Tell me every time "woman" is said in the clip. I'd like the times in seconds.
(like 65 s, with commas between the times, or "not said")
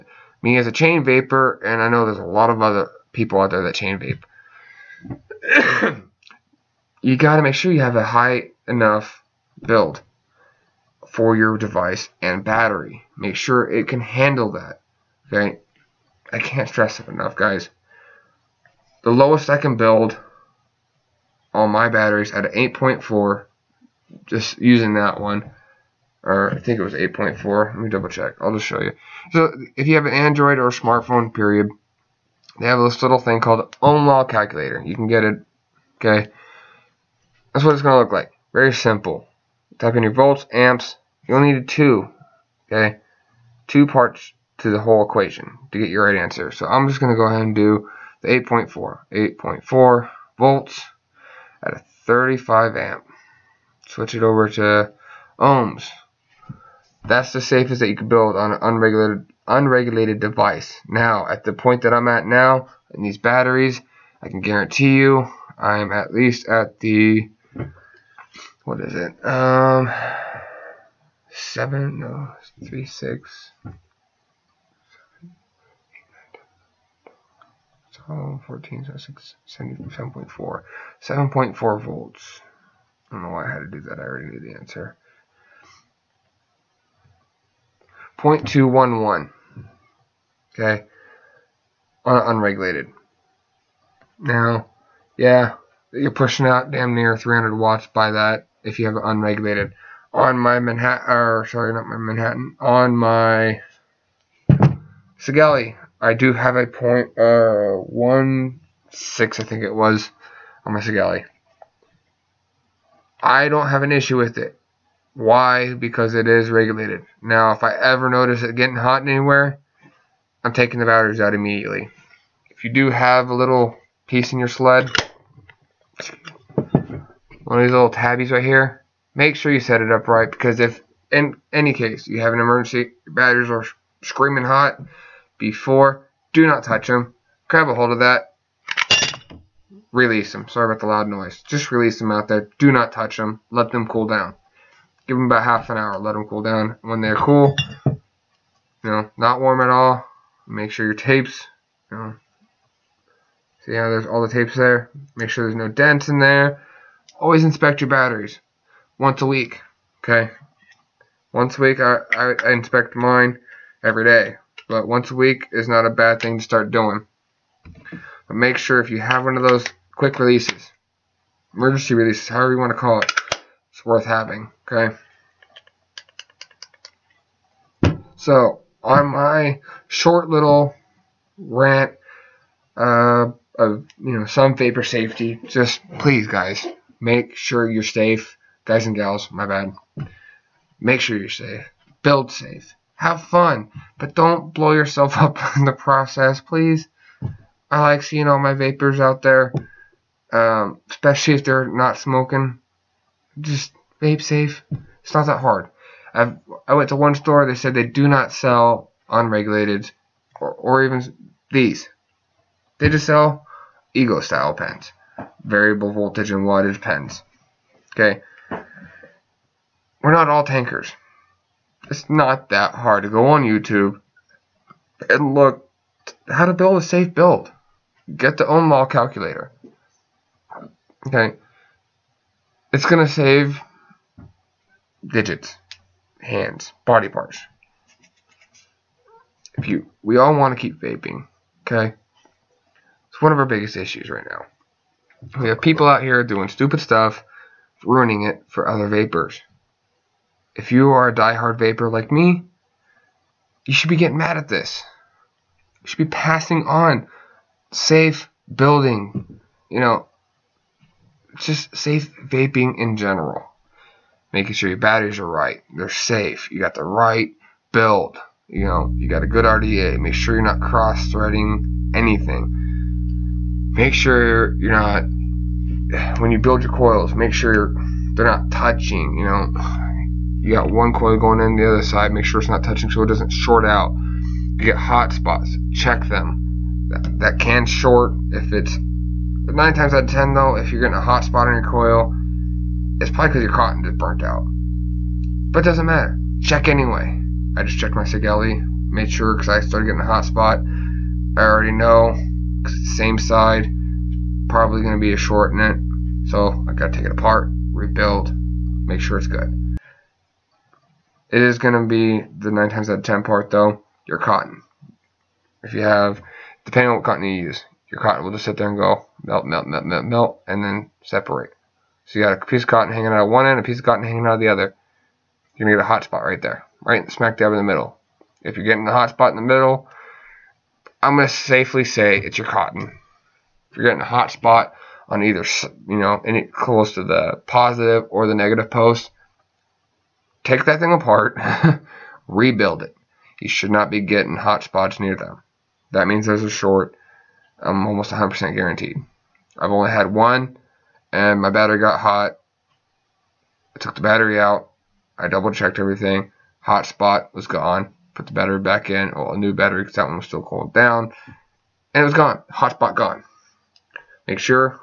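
not said.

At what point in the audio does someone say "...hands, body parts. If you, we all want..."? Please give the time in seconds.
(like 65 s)
236 s.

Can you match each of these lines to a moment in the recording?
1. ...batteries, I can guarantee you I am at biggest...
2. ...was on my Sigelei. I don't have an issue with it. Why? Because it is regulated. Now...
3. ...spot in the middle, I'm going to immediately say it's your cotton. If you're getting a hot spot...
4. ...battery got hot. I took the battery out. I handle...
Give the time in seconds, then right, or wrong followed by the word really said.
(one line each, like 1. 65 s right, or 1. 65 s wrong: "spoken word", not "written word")
1. 63 s wrong: "least", not "biggest"
2. 109 s right
3. 329 s wrong: "safely", not "immediately"
4. 351 s wrong: "double", not "handle".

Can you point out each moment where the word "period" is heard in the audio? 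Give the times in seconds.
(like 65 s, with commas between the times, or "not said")
31 s.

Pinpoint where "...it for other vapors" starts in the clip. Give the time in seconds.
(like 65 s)
248 s.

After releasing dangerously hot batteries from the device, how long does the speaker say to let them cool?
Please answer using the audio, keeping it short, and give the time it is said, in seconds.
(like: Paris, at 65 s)
half an hour, at 145 s.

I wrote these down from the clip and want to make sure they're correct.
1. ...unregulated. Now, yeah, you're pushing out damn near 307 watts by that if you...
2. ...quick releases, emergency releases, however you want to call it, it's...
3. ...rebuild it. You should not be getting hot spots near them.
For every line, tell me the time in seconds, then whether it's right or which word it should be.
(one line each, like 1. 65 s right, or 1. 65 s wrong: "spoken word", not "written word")
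1. 92 s wrong: "300", not "307"
2. 169 s right
3. 342 s right.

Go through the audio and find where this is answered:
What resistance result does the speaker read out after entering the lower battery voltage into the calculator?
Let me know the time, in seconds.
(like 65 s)
88 s.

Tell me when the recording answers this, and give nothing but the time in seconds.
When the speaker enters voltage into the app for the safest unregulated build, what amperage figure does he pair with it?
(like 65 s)
52 s.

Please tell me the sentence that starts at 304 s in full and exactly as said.
Probably going to be a short in it.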